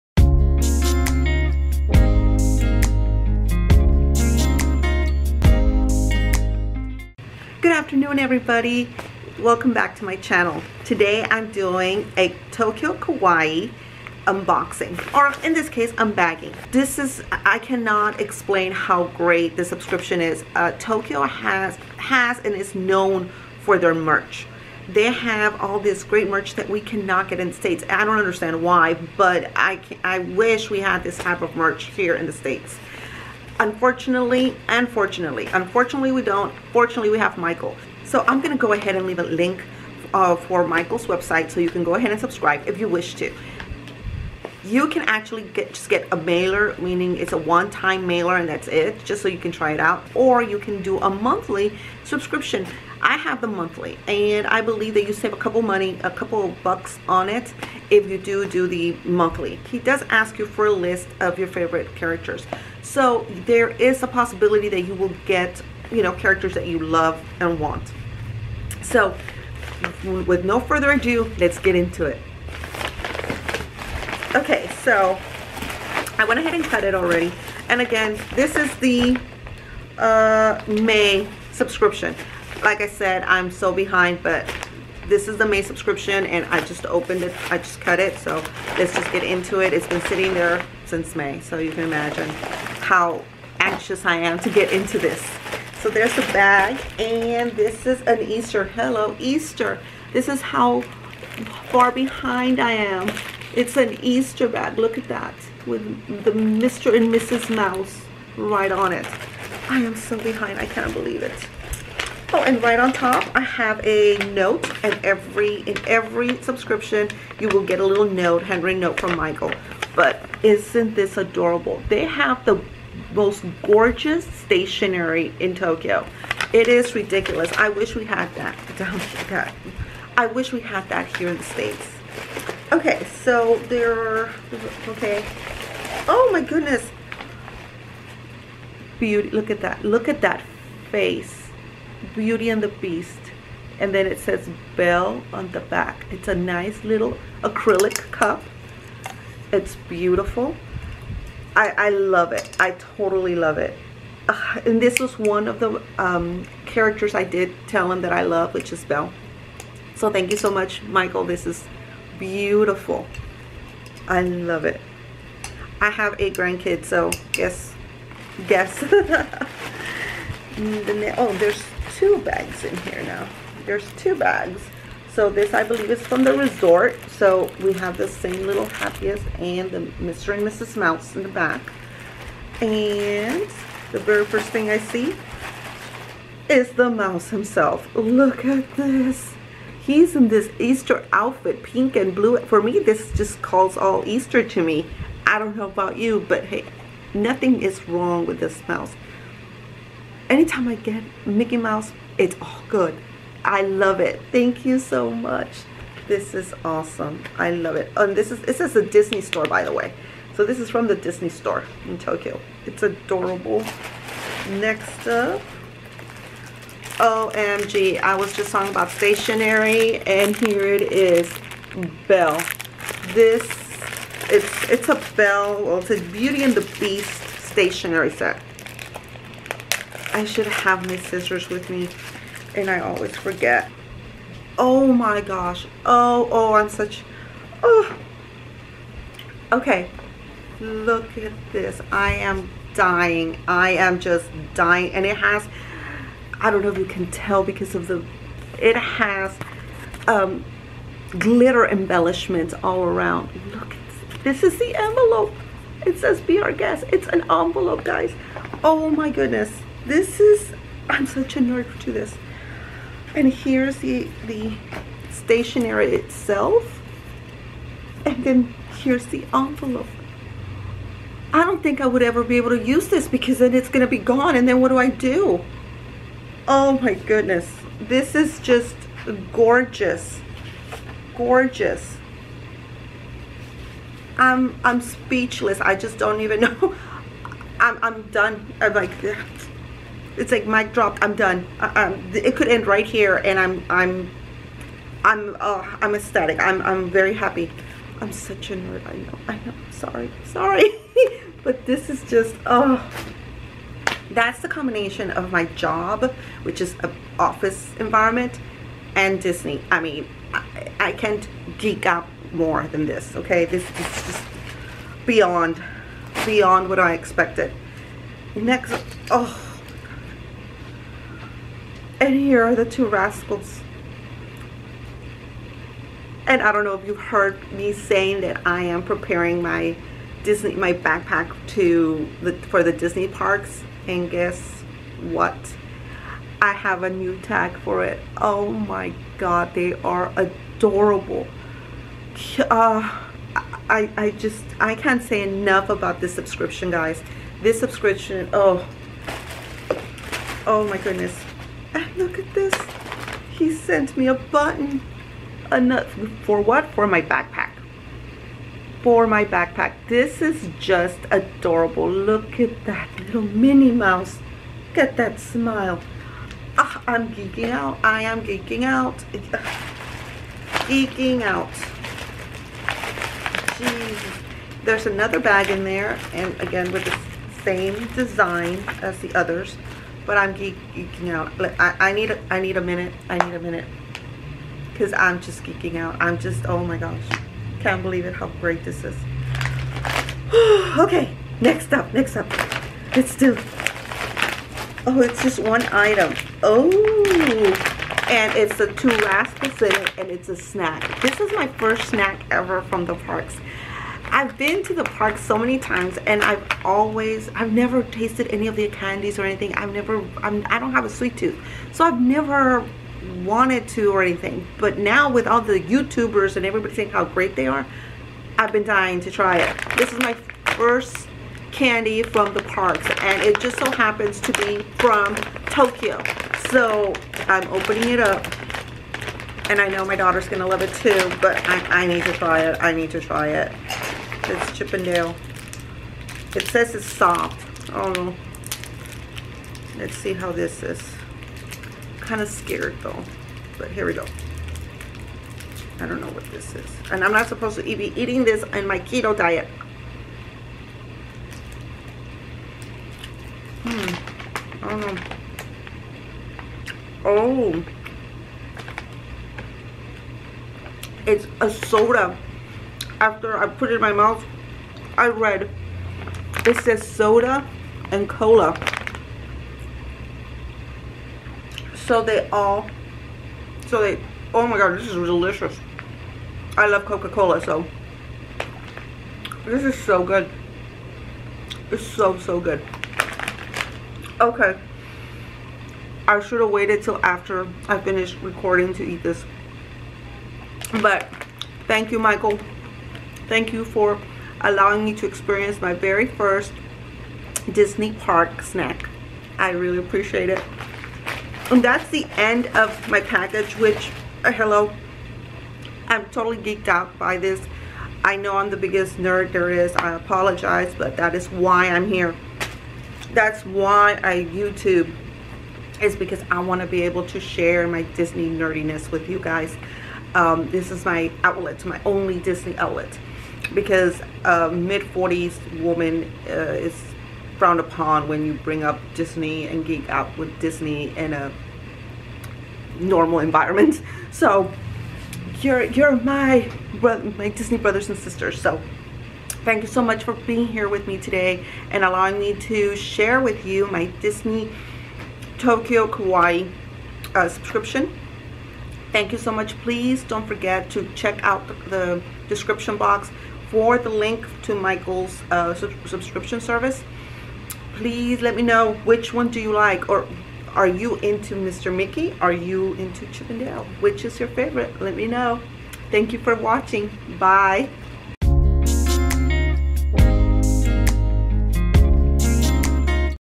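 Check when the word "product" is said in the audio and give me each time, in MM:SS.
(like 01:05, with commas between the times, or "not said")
not said.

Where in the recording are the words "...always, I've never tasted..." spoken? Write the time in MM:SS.
06:46.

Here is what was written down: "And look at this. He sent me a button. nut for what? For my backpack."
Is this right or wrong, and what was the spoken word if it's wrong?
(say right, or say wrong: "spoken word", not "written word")
right.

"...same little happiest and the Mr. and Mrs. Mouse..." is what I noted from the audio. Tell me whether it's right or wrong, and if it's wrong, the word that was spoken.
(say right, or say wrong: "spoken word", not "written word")
right.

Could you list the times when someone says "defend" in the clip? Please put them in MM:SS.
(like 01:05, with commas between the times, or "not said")
not said.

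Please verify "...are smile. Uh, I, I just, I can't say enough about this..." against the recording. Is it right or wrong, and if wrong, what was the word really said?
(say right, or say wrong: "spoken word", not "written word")
wrong: "adorable", not "smile".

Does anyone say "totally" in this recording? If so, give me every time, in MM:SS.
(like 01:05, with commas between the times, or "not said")
02:32, 08:26.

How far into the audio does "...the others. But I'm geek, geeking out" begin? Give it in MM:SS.
06:18.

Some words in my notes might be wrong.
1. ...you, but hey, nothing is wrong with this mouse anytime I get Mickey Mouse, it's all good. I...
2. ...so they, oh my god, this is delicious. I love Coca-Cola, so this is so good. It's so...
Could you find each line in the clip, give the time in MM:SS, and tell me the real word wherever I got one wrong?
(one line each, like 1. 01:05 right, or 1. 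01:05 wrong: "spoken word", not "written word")
1. 03:15 right
2. 07:53 right.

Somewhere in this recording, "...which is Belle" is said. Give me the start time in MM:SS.
02:38.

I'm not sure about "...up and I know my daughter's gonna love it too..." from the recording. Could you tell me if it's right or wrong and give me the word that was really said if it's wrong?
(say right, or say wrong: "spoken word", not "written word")
right.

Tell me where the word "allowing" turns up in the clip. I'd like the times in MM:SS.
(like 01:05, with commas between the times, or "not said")
08:14, 09:01.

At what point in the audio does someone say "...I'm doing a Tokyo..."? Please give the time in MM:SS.
00:11.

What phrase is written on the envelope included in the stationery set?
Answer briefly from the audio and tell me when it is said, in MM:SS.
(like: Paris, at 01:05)
Be our guest, at 04:16.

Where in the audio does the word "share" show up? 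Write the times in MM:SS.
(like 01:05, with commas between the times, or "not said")
08:37, 09:02.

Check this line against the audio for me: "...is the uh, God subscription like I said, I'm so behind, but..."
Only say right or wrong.
wrong.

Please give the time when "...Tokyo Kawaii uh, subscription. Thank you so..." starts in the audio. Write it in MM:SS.
09:05.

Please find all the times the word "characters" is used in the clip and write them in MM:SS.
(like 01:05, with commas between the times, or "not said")
01:01, 01:06, 02:36.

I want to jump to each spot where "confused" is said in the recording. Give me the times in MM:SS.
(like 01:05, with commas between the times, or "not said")
not said.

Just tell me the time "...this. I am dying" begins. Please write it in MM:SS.
04:01.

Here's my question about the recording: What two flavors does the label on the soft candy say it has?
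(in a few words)
soda and cola.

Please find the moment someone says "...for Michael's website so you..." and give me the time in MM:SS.
00:40.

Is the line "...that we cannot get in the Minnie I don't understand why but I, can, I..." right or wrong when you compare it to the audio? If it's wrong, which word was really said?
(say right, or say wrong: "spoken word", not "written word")
wrong: "States", not "Minnie".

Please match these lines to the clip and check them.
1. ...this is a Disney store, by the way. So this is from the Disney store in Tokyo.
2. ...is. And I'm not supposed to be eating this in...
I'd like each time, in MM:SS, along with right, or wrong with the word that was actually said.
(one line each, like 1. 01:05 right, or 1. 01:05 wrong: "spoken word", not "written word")
1. 03:28 right
2. 07:26 right.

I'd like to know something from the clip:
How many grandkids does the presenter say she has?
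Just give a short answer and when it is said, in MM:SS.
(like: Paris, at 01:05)
8, at 02:46.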